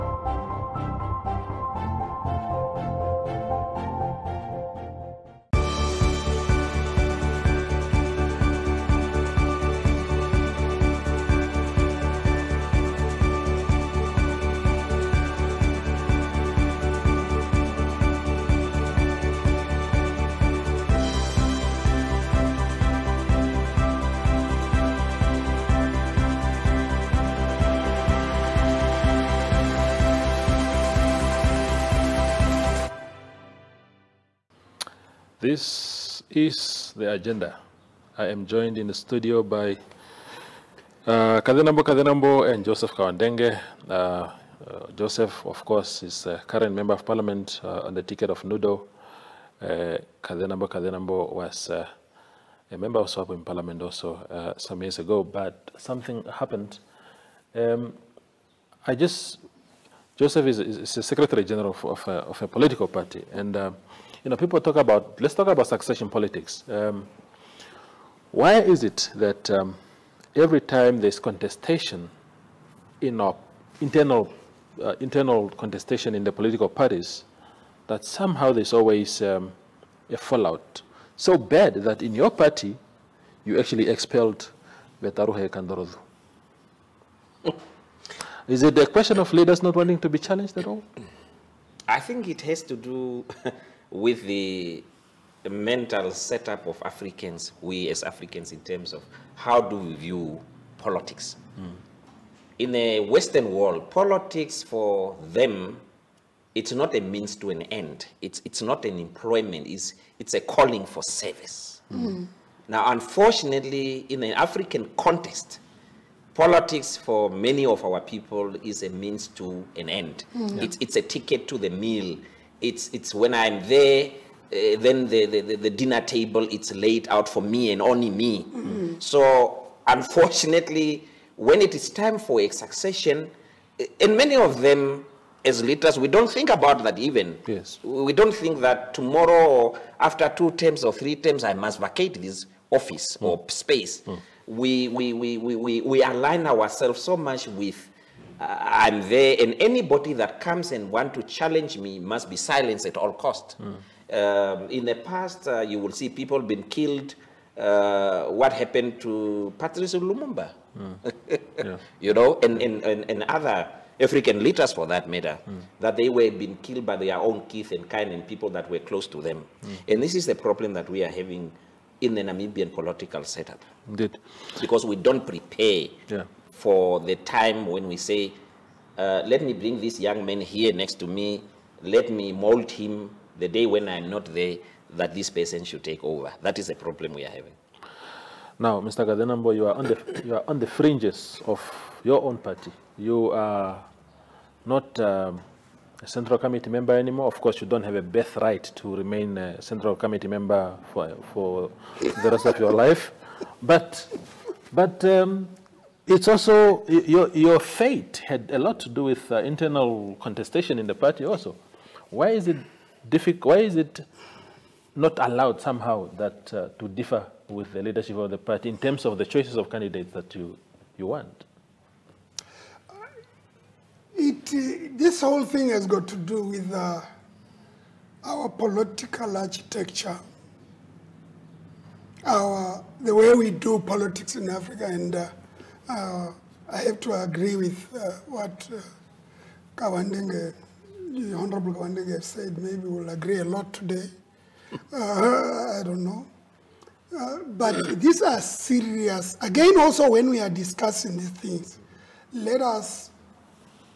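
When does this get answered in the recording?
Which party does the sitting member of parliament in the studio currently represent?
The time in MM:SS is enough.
00:48.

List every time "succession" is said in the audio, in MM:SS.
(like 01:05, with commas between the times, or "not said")
01:05, 02:12.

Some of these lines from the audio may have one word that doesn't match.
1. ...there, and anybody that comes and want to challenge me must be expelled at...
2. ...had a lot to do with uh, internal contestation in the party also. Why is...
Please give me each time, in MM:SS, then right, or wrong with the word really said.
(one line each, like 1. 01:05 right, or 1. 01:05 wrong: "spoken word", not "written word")
1. 02:29 wrong: "silenced", not "expelled"
2. 03:28 right.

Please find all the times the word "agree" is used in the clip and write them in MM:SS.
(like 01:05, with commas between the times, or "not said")
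03:57, 04:03.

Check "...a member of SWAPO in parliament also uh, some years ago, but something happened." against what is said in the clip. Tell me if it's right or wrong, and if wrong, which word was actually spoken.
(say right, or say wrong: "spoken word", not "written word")
right.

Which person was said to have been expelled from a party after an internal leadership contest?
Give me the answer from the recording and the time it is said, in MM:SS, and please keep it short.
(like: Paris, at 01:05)
Vetaruhe Kandorozu, at 01:25.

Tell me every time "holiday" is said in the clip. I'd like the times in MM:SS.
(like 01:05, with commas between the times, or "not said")
not said.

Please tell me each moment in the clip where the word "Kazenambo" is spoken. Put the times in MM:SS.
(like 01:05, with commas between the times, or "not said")
00:41, 00:50, 03:09.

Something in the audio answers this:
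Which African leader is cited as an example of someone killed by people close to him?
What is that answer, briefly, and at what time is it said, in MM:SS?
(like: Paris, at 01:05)
Patrice Lumumba, at 02:39.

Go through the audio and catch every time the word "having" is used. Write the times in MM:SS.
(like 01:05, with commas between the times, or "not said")
02:51, 03:07.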